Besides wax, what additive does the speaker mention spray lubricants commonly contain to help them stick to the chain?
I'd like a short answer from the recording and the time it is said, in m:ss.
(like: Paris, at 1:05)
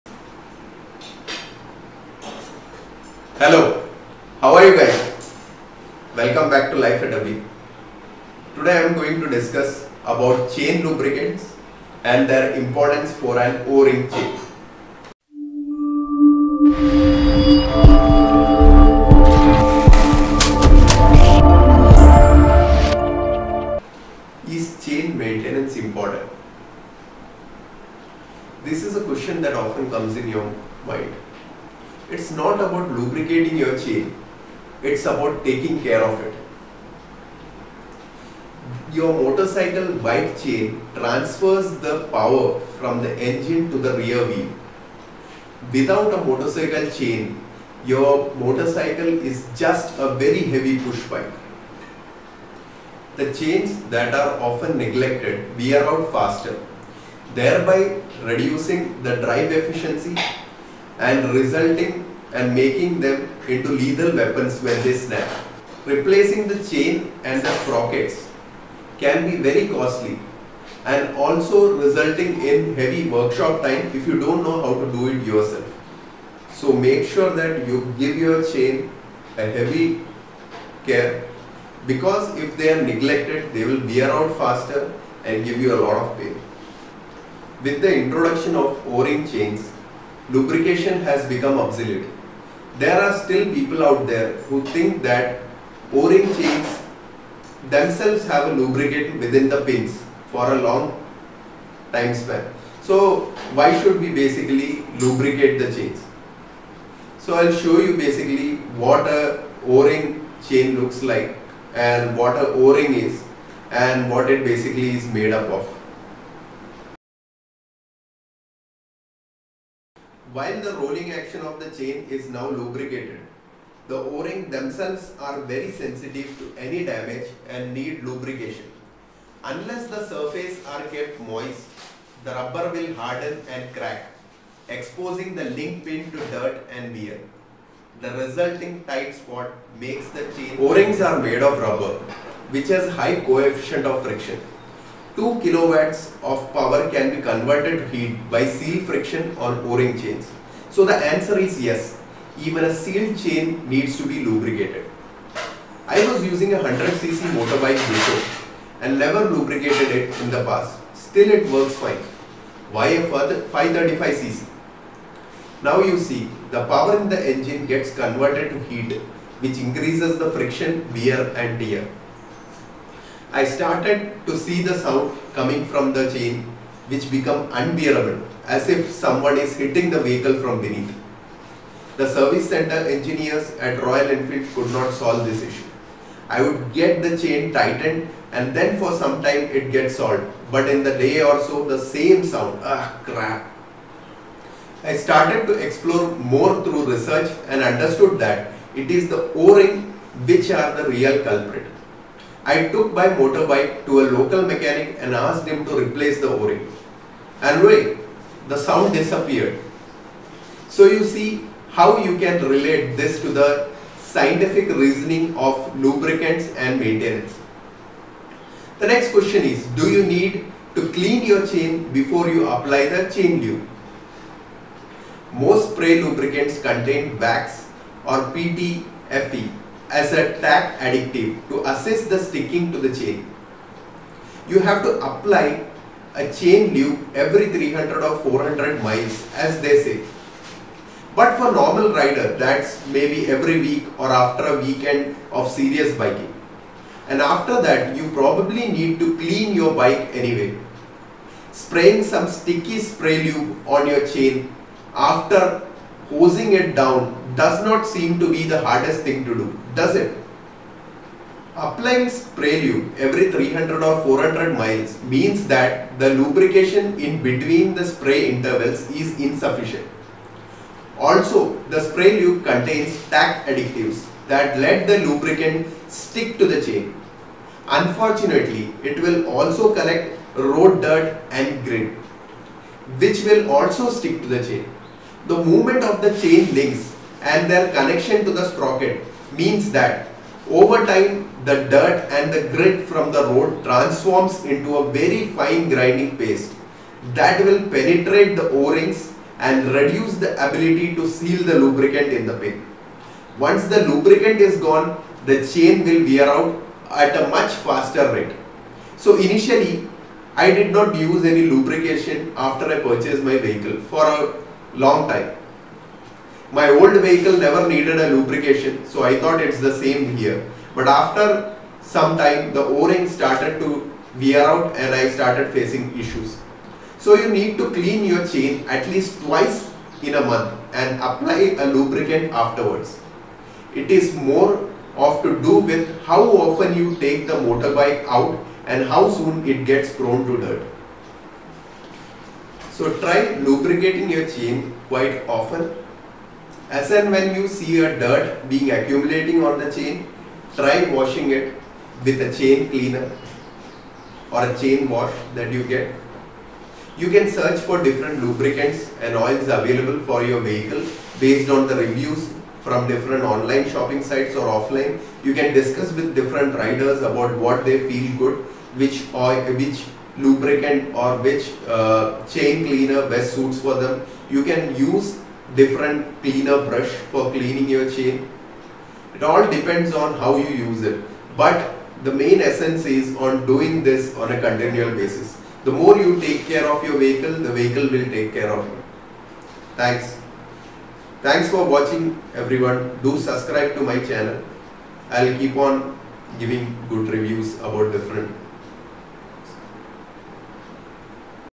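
PTFE, at 3:48.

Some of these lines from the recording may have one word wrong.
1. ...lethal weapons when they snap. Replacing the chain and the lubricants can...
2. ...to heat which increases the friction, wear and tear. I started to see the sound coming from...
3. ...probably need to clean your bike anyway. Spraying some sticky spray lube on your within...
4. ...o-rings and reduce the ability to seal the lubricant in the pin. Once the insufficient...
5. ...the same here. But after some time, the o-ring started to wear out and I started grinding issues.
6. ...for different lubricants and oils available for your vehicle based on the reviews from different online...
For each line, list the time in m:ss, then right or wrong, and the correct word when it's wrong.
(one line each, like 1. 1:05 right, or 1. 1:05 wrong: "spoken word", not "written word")
1. 1:03 wrong: "sprockets", not "lubricants"
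2. 2:48 right
3. 4:08 wrong: "chain", not "within"
4. 4:58 wrong: "lubricant", not "insufficient"
5. 5:19 wrong: "facing", not "grinding"
6. 5:57 right.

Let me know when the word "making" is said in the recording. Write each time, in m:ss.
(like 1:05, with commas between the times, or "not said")
1:02.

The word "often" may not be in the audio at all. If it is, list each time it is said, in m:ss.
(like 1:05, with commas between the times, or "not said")
0:29, 0:54, 5:36, 5:45.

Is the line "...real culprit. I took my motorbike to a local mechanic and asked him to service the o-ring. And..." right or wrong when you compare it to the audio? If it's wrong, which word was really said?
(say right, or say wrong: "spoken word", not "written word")
wrong: "replace", not "service".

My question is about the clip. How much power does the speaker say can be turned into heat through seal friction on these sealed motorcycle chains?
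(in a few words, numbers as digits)
2 kilowatts.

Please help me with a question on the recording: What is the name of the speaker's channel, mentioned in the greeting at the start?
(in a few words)
Life at W.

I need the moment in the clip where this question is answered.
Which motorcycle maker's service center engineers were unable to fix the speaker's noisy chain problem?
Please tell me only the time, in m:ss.
3:03.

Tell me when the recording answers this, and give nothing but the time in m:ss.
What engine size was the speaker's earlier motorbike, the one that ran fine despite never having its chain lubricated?
2:36.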